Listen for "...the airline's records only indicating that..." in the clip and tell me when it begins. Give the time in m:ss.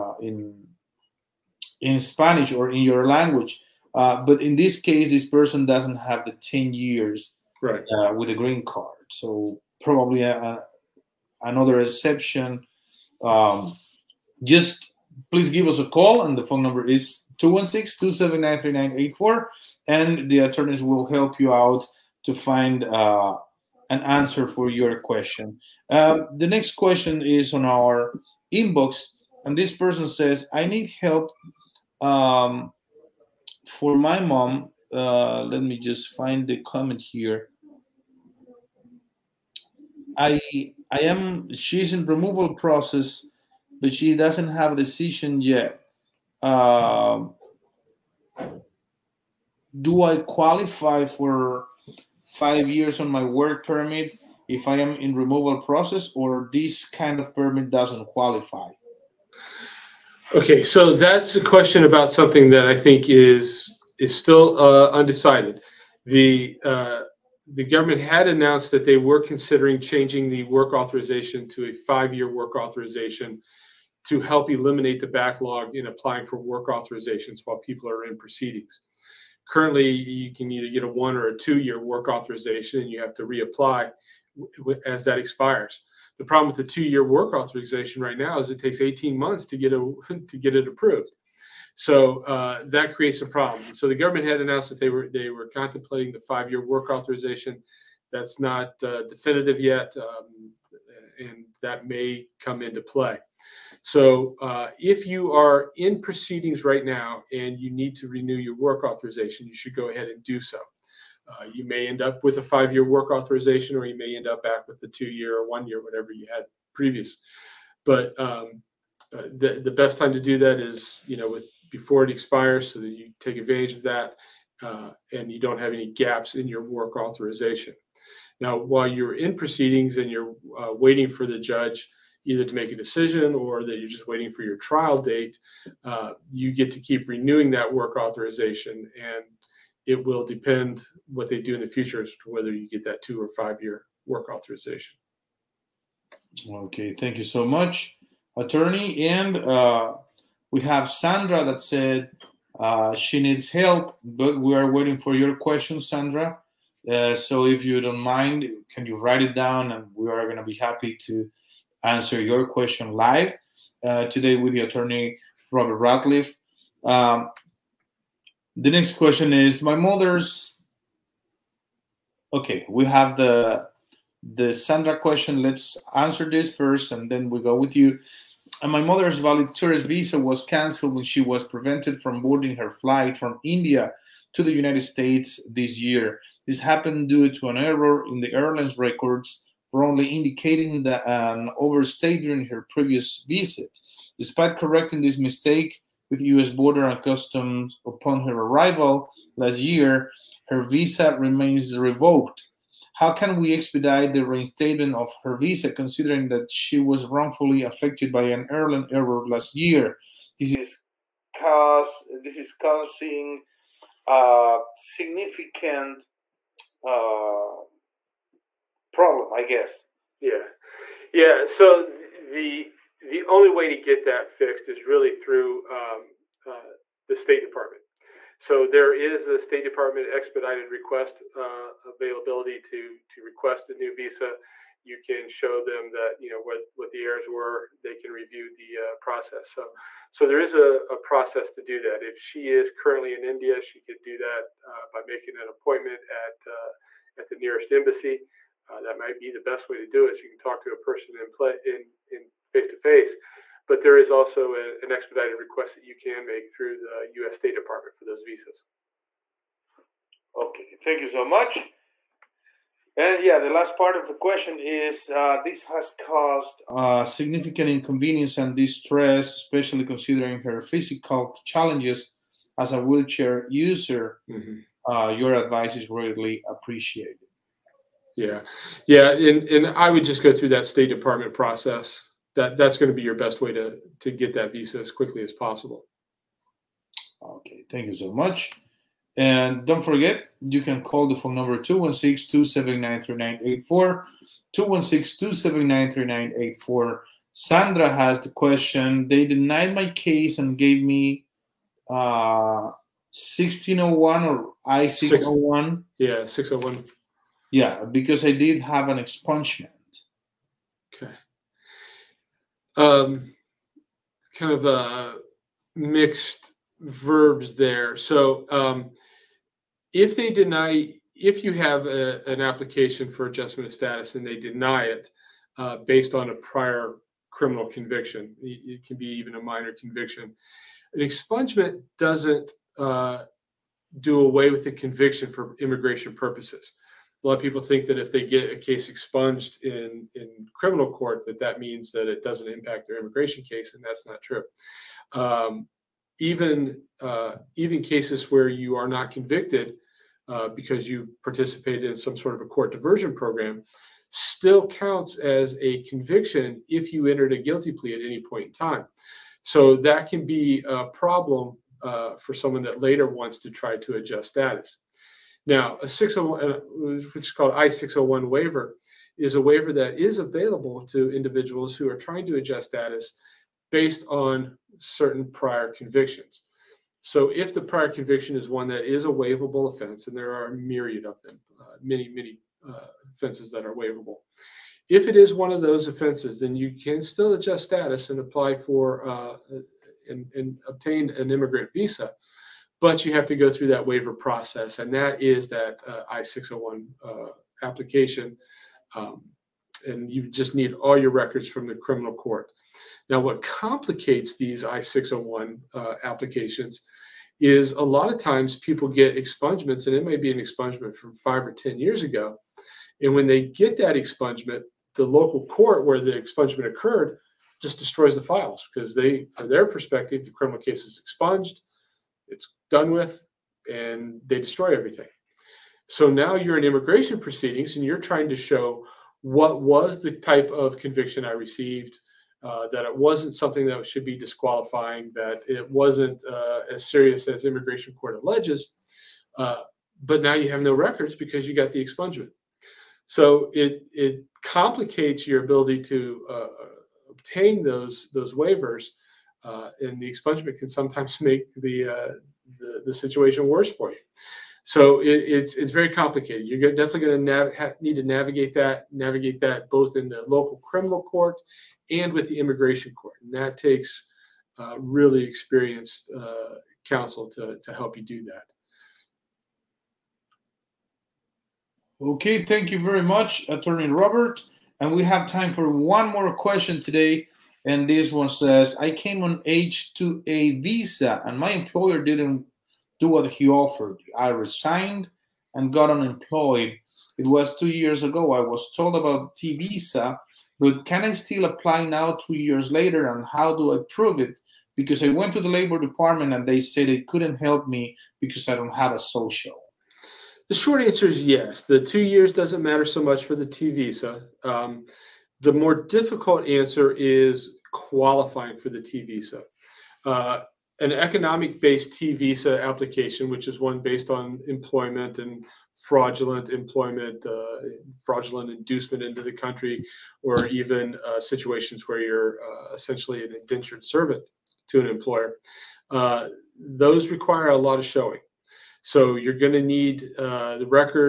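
3:08.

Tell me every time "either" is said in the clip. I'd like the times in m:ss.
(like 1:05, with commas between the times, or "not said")
1:20, 2:12.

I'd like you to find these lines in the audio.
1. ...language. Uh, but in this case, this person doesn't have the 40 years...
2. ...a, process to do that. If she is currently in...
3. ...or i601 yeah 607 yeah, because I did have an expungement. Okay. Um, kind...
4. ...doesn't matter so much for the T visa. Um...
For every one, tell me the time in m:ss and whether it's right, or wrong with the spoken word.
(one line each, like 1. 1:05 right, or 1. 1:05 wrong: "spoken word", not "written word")
1. 0:03 wrong: "10", not "40"
2. 4:00 right
3. 5:04 wrong: "601", not "607"
4. 8:22 right.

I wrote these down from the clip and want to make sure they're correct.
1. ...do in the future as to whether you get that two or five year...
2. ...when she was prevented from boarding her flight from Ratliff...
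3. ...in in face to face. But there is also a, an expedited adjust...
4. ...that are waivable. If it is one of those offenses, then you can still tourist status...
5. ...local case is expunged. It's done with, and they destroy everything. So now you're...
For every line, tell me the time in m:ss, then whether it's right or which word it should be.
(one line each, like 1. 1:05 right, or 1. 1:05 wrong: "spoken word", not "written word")
1. 2:21 right
2. 3:00 wrong: "India", not "Ratliff"
3. 4:11 wrong: "request", not "adjust"
4. 6:23 wrong: "adjust", not "tourist"
5. 7:00 wrong: "criminal", not "local".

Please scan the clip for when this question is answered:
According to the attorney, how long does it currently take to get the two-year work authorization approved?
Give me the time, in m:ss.
1:28.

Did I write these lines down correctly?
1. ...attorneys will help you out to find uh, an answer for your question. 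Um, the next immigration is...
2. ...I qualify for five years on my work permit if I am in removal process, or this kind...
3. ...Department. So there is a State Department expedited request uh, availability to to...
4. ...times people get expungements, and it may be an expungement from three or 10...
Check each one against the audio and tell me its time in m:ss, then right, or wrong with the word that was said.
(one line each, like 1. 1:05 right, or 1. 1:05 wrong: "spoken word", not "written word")
1. 0:20 wrong: "question", not "immigration"
2. 0:50 right
3. 3:47 right
4. 6:48 wrong: "five", not "three".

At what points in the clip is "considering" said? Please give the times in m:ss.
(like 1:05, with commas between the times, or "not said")
1:09, 3:25, 4:29.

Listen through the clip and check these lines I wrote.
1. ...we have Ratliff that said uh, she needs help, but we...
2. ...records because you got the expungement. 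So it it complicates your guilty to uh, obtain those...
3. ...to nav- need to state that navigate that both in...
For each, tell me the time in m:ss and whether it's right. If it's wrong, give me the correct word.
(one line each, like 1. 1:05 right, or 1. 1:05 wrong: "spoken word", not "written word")
1. 2:30 wrong: "Sandra", not "Ratliff"
2. 7:20 wrong: "ability", not "guilty"
3. 7:37 wrong: "navigate", not "state".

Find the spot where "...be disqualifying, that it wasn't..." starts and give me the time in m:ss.
7:14.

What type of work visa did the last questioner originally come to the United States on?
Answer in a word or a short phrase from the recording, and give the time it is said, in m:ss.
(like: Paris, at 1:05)
H2A, at 7:59.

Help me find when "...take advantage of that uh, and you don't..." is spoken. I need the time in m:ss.
2:03.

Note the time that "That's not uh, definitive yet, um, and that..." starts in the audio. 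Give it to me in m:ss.
1:38.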